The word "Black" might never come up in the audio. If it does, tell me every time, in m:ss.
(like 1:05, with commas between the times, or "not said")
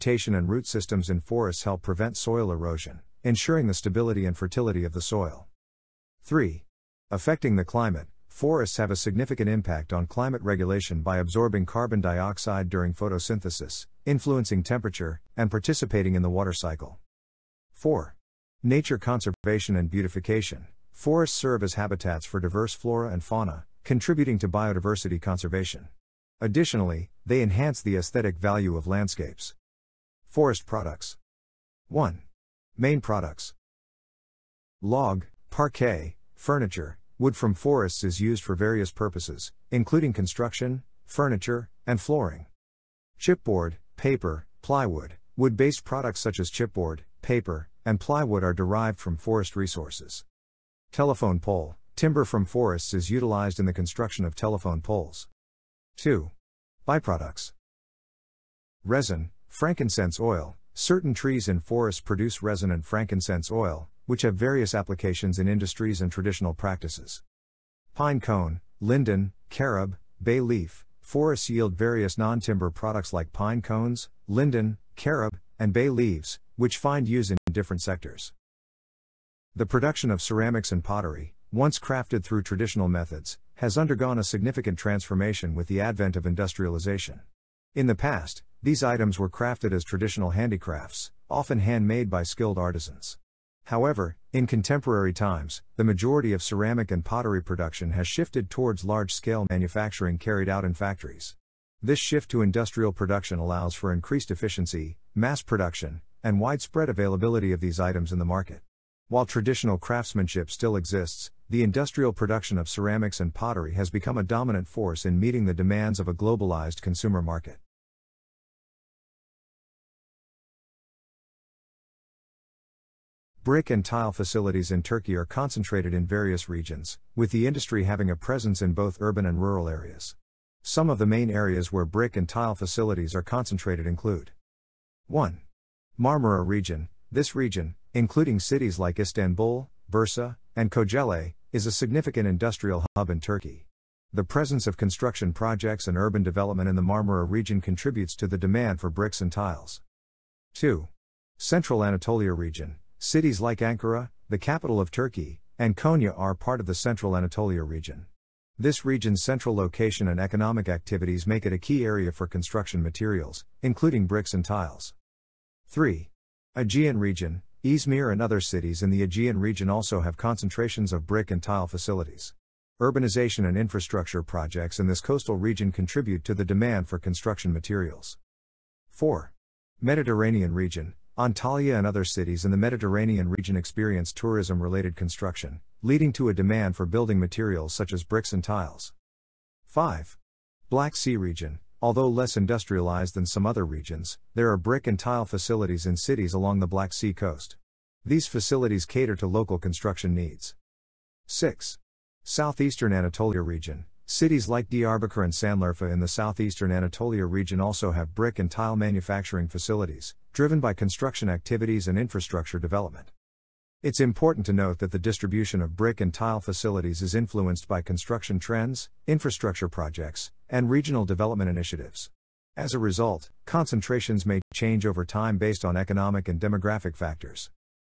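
3:10, 3:16.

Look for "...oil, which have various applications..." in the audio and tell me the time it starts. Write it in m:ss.
1:03.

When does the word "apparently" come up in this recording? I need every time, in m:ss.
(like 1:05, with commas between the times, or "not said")
not said.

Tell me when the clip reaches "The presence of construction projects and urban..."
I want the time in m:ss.
2:24.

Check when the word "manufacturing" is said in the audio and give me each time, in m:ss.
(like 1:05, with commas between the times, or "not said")
1:39, 3:28.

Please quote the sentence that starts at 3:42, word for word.
As a result, concentrations may change over time based on economic and demographic factors.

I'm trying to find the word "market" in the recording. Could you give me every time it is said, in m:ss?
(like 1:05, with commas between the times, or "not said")
1:48, 1:57.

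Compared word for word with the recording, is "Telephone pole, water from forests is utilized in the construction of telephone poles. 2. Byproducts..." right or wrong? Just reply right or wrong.
wrong.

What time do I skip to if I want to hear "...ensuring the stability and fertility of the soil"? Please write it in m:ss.
0:03.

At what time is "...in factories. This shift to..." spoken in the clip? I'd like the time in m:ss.
1:40.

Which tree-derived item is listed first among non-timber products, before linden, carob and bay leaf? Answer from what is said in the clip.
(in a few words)
Pine cone.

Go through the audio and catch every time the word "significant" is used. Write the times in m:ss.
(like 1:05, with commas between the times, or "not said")
0:08, 1:24, 2:21.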